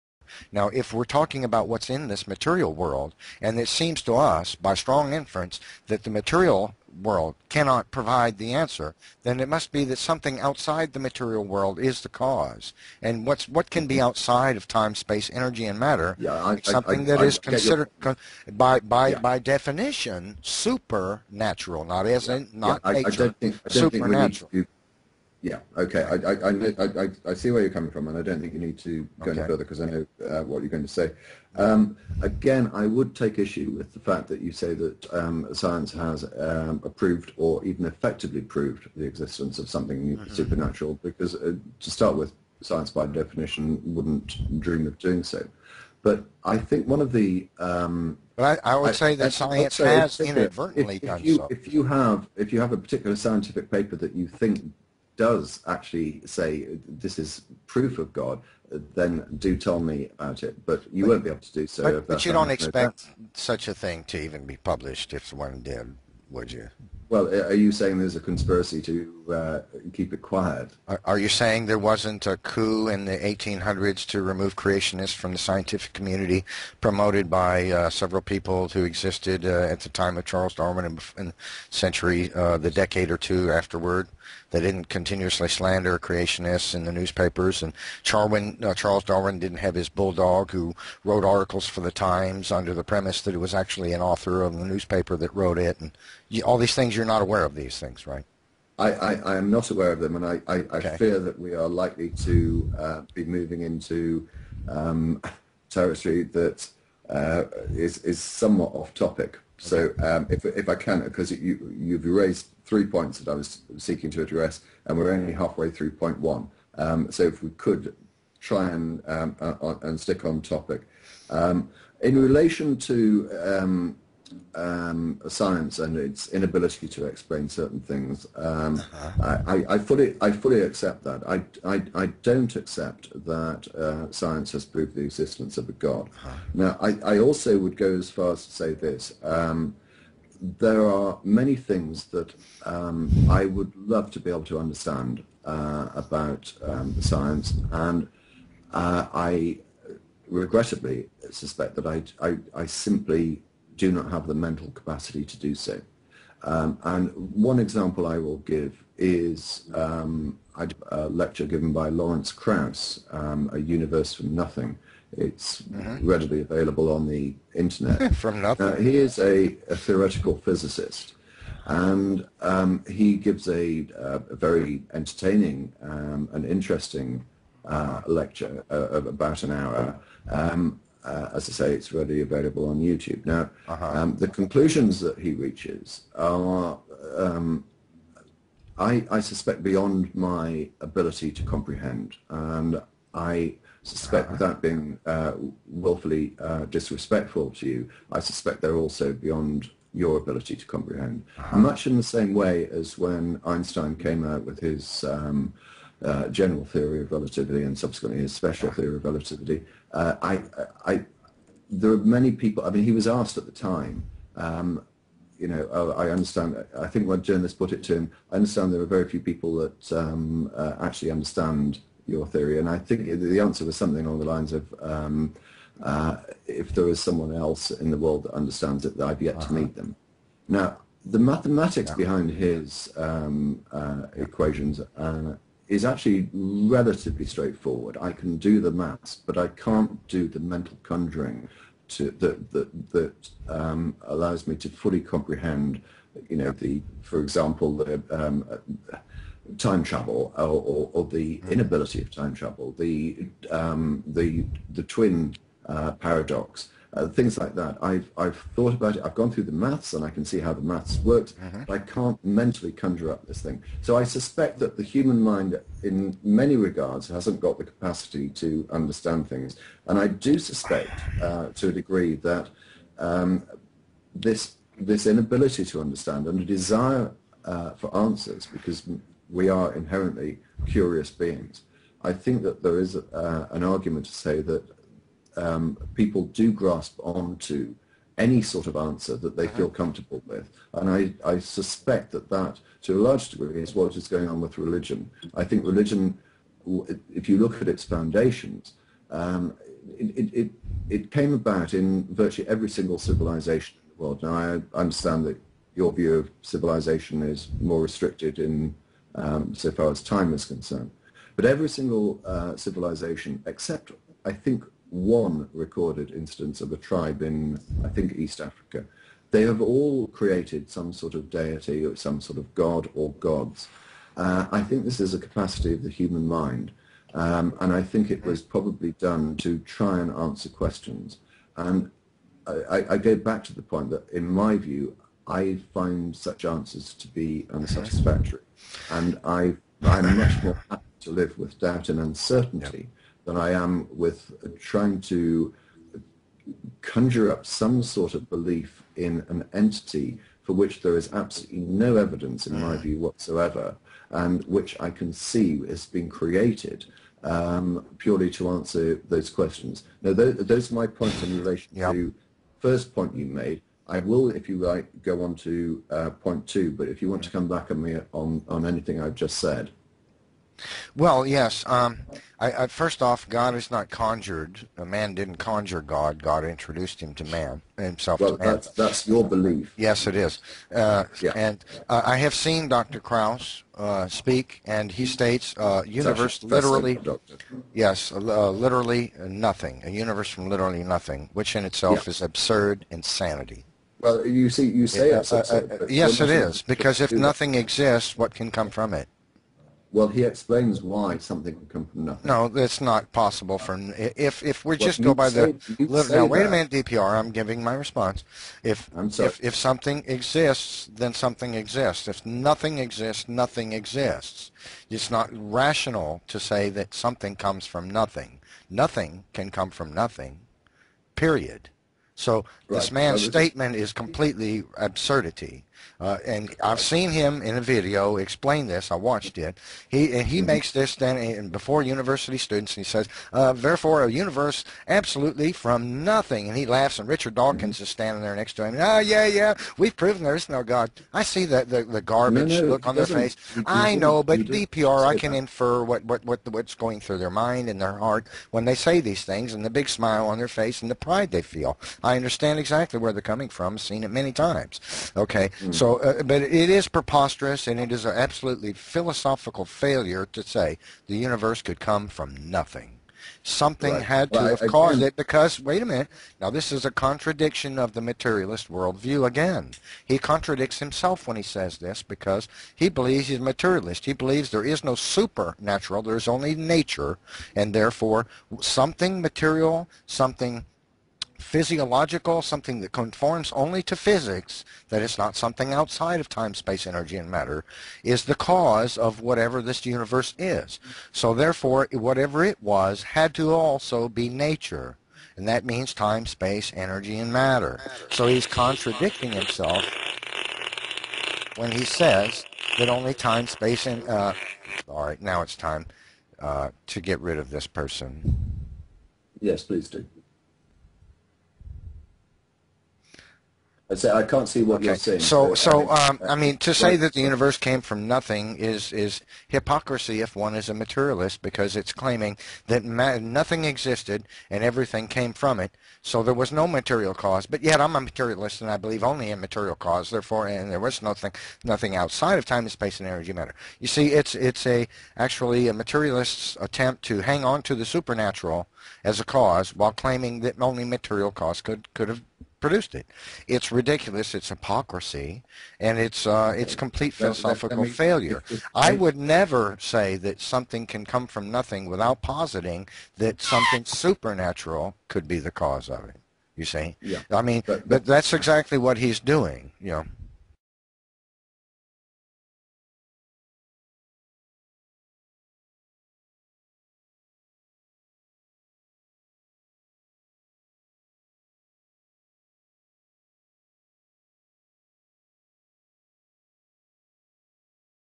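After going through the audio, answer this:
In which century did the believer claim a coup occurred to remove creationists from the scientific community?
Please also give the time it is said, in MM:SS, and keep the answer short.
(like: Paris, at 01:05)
The 1800s, at 01:13.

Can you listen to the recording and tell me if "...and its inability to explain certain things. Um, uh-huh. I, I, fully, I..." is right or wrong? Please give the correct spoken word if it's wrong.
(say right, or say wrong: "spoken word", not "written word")
right.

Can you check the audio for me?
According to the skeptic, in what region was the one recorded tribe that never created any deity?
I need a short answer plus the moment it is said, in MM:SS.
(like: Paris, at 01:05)
East Africa, at 05:18.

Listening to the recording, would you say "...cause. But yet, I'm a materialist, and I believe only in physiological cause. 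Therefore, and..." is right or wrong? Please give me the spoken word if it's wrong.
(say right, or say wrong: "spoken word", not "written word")
wrong: "material", not "physiological".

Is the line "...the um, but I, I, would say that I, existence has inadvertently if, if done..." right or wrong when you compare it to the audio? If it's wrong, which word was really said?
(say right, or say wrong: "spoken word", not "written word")
wrong: "science", not "existence".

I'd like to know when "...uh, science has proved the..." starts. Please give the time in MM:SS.
02:13.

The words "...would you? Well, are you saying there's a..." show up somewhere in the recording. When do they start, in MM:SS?
01:06.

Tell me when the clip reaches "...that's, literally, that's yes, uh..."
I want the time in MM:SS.
06:26.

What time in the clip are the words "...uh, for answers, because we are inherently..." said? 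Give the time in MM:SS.
04:37.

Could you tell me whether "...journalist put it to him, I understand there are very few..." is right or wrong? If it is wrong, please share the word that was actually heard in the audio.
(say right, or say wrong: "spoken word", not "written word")
right.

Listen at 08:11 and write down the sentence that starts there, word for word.
So therefore, whatever it was had to also be nature.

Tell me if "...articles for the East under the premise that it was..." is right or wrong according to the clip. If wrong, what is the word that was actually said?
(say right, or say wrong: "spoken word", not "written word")
wrong: "Times", not "East".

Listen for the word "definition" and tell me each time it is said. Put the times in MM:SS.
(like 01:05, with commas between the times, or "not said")
00:19, 00:43.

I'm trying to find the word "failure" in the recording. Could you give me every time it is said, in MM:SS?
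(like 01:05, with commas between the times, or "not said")
07:39, 09:07.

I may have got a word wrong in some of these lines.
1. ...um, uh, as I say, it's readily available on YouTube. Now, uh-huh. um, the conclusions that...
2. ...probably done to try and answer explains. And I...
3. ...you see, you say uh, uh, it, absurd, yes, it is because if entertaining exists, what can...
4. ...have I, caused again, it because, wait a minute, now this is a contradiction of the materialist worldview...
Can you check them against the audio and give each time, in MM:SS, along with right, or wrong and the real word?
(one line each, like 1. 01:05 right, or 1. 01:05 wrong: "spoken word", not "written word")
1. 03:00 right
2. 05:28 wrong: "questions", not "explains"
3. 06:34 wrong: "nothing", not "entertaining"
4. 07:44 right.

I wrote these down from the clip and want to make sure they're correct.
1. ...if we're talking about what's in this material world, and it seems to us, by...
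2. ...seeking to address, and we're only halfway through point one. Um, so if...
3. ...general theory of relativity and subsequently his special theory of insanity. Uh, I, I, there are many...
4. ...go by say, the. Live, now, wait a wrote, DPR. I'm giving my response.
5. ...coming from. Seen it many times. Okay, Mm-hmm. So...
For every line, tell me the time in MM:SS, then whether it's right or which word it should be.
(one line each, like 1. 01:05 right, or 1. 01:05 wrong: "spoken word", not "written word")
1. 00:00 right
2. 01:53 right
3. 03:26 wrong: "relativity", not "insanity"
4. 06:45 wrong: "minute", not "wrote"
5. 07:33 right.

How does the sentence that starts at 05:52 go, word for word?
view, whatsoever, and which I can see has been created um, purely to answer those questions.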